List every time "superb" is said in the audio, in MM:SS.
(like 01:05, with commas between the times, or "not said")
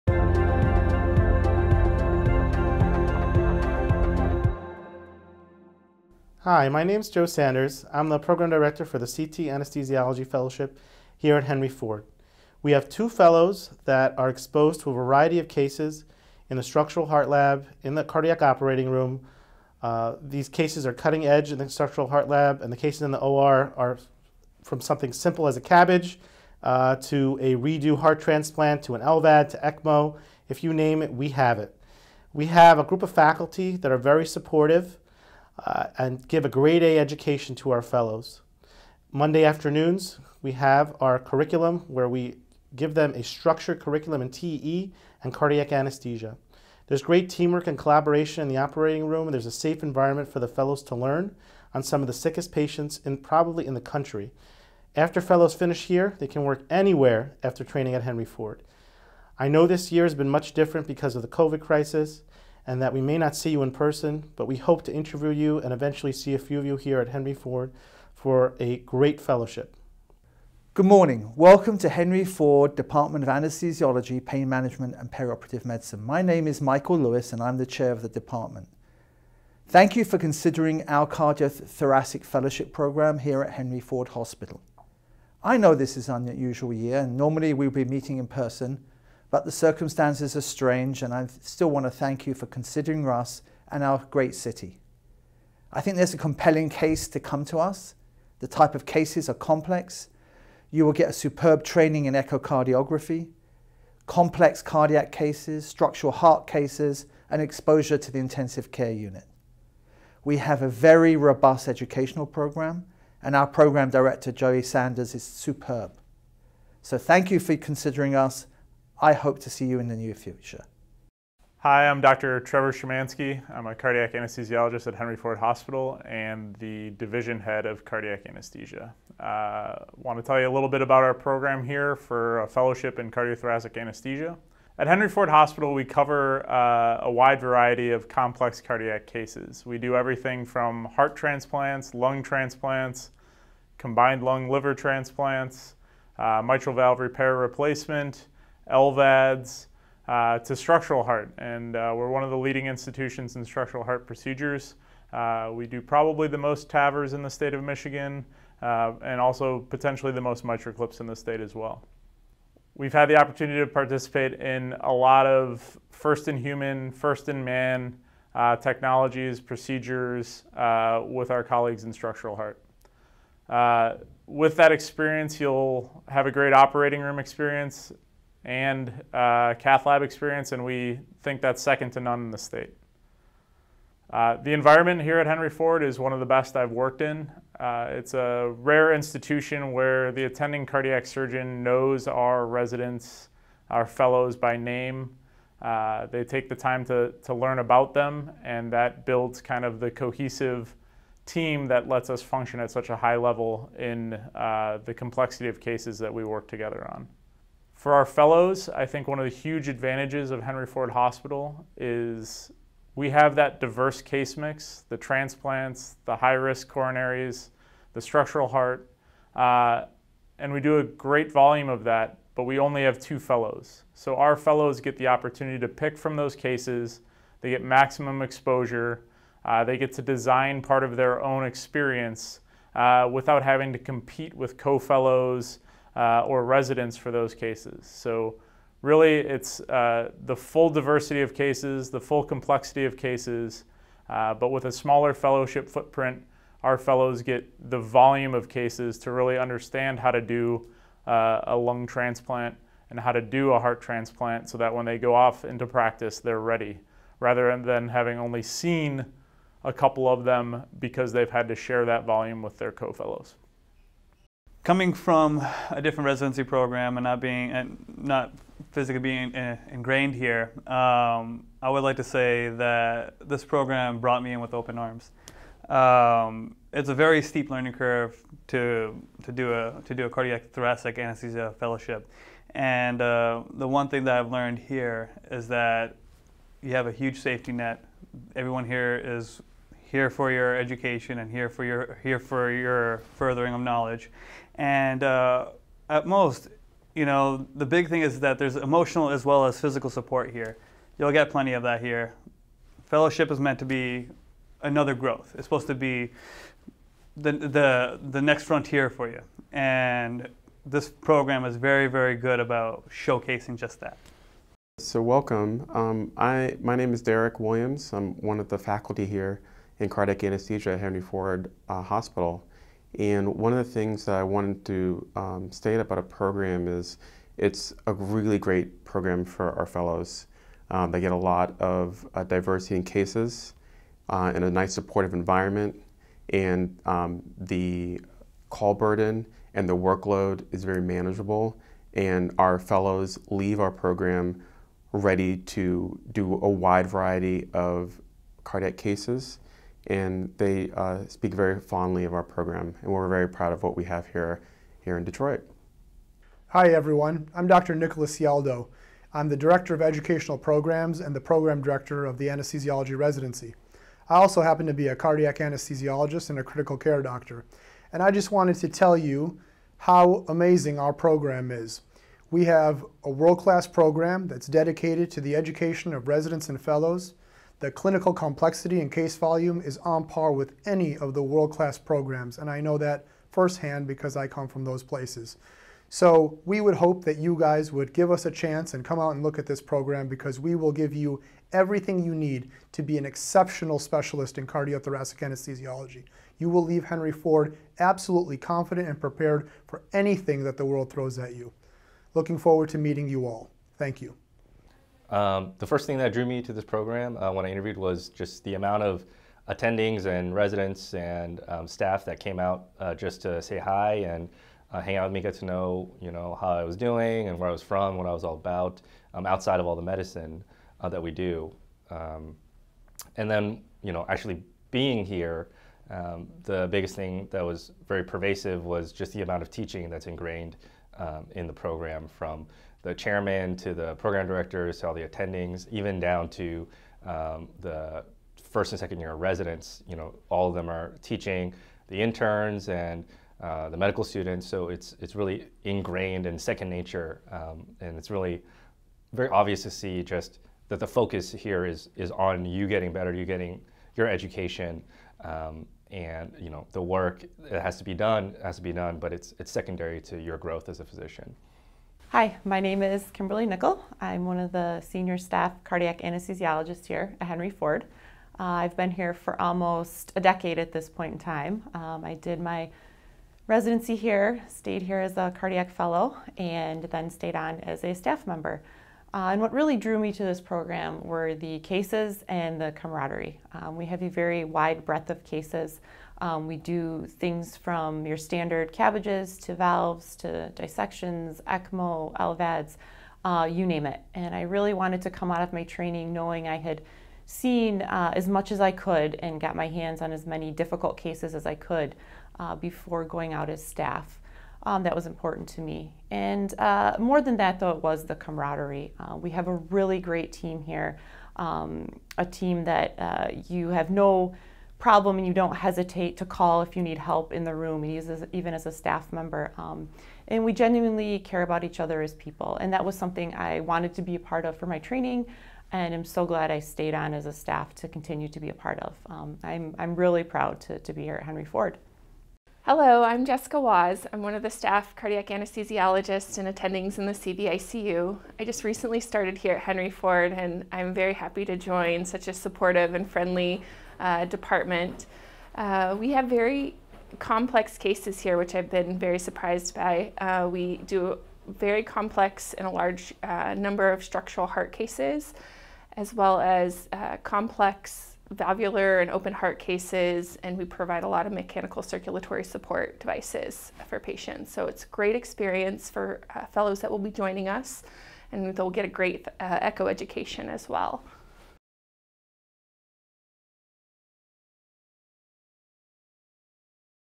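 01:41, 01:55.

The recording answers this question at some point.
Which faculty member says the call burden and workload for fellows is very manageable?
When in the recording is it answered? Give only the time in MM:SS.
05:17.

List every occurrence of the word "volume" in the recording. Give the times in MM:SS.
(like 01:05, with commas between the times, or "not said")
03:41, 04:07, 04:22, 06:19.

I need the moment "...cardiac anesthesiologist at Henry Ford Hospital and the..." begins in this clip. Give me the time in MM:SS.
02:03.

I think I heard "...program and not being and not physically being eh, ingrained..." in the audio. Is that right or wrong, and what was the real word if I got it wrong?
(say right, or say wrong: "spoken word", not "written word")
right.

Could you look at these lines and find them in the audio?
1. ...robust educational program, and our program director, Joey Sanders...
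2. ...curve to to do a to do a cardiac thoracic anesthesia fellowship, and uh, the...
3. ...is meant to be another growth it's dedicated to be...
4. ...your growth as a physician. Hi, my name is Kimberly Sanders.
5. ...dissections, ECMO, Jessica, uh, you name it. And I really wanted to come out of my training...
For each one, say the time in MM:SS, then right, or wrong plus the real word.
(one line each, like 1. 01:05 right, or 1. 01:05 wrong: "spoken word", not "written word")
1. 01:51 right
2. 04:37 right
3. 05:03 wrong: "supposed", not "dedicated"
4. 07:40 wrong: "Nickel", not "Sanders"
5. 08:10 wrong: "LVADs", not "Jessica".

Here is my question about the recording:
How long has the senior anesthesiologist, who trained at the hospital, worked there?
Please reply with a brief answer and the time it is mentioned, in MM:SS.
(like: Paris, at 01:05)
Almost a decade, at 07:49.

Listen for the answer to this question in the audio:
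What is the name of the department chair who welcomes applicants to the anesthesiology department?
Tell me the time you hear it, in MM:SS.
01:16.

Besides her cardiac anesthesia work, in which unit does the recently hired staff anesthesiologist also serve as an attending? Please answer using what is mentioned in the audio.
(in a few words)
CVICU.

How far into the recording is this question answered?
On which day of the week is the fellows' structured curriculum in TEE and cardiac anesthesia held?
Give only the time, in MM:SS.
00:39.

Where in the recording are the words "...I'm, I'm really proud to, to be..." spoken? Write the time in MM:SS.
08:49.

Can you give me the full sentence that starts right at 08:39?
Um, and we genuinely care about each other as people.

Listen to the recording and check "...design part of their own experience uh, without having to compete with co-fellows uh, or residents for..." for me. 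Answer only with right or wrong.
right.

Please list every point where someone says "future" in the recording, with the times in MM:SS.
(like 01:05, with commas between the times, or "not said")
02:00.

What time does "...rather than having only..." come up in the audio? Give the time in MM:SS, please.
04:17.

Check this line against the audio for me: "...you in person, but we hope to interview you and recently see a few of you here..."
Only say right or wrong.
wrong.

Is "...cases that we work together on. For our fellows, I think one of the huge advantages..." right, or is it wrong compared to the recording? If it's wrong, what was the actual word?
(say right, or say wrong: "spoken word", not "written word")
right.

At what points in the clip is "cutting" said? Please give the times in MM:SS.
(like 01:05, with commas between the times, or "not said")
00:20.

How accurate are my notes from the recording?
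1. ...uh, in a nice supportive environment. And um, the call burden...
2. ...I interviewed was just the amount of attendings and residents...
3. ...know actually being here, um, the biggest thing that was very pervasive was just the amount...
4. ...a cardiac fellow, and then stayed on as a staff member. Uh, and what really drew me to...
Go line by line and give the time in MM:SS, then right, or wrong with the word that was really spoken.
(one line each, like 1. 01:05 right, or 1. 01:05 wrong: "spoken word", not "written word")
1. 05:34 right
2. 06:47 right
3. 07:03 right
4. 07:55 right.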